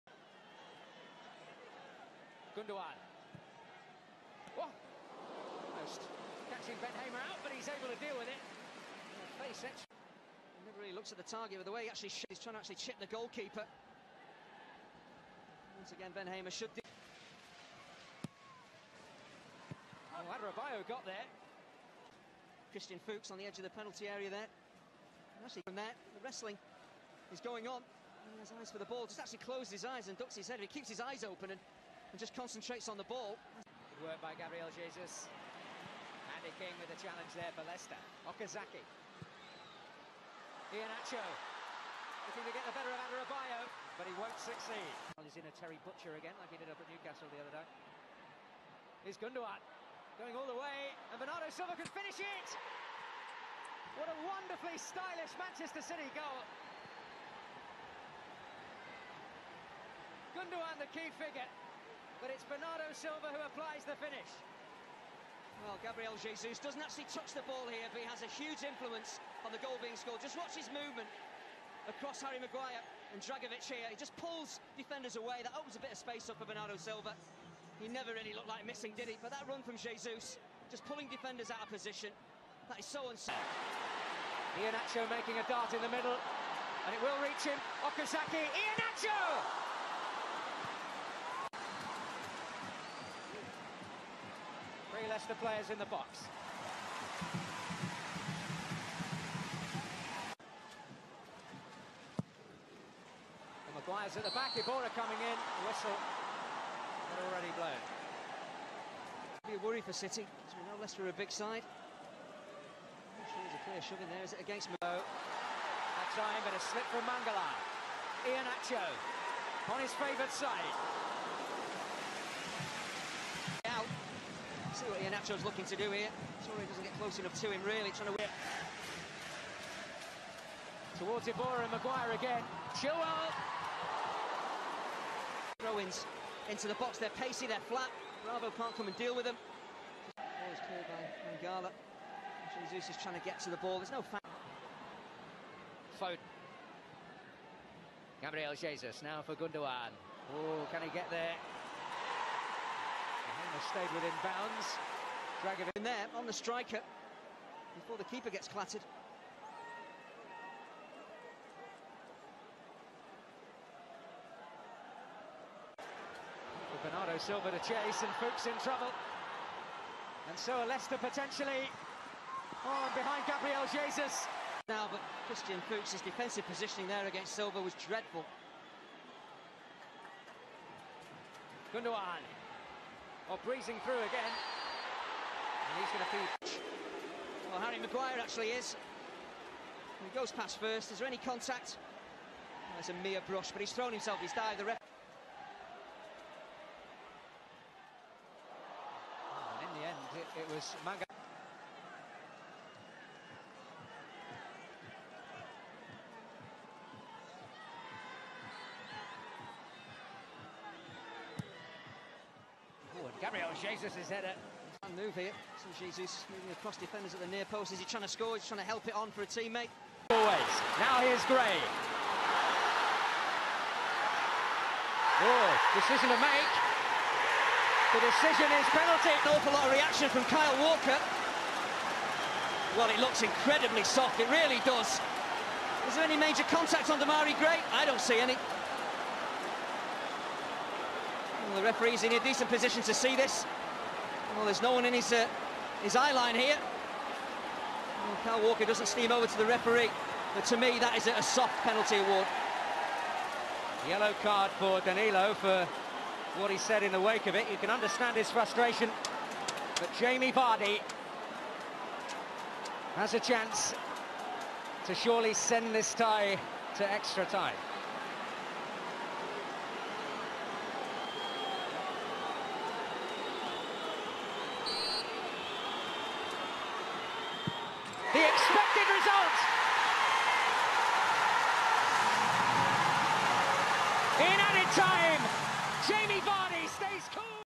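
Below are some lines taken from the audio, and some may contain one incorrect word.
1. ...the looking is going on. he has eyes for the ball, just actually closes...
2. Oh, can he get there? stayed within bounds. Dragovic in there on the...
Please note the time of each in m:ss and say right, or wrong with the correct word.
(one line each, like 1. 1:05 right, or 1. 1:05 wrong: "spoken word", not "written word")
1. 0:26 wrong: "wrestling", not "looking"
2. 2:30 right.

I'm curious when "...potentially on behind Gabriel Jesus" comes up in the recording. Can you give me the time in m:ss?
2:50.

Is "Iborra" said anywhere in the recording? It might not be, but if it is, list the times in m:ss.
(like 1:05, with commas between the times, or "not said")
1:44, 2:11.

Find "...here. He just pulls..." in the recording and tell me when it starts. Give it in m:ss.
1:13.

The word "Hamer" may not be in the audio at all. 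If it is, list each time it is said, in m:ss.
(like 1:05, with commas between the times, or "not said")
0:06, 0:16.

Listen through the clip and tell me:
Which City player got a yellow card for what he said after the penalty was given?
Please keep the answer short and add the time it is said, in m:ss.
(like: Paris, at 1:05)
Danilo, at 4:13.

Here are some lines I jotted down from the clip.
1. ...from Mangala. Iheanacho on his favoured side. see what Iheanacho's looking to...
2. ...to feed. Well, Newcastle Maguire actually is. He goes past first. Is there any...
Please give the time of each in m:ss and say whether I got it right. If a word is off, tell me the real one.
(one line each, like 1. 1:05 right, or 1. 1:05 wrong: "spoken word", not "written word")
1. 1:56 right
2. 3:06 wrong: "Harry", not "Newcastle".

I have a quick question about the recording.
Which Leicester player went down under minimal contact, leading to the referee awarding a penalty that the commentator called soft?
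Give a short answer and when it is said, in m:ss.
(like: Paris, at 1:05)
Demarai Gray, at 3:56.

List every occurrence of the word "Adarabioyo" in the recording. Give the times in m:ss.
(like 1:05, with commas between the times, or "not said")
0:20, 0:43.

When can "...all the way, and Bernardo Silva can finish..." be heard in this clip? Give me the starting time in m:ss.
0:50.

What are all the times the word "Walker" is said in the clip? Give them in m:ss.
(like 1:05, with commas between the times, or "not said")
3:50, 4:08.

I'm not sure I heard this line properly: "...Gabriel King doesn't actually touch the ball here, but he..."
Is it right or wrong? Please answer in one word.
wrong.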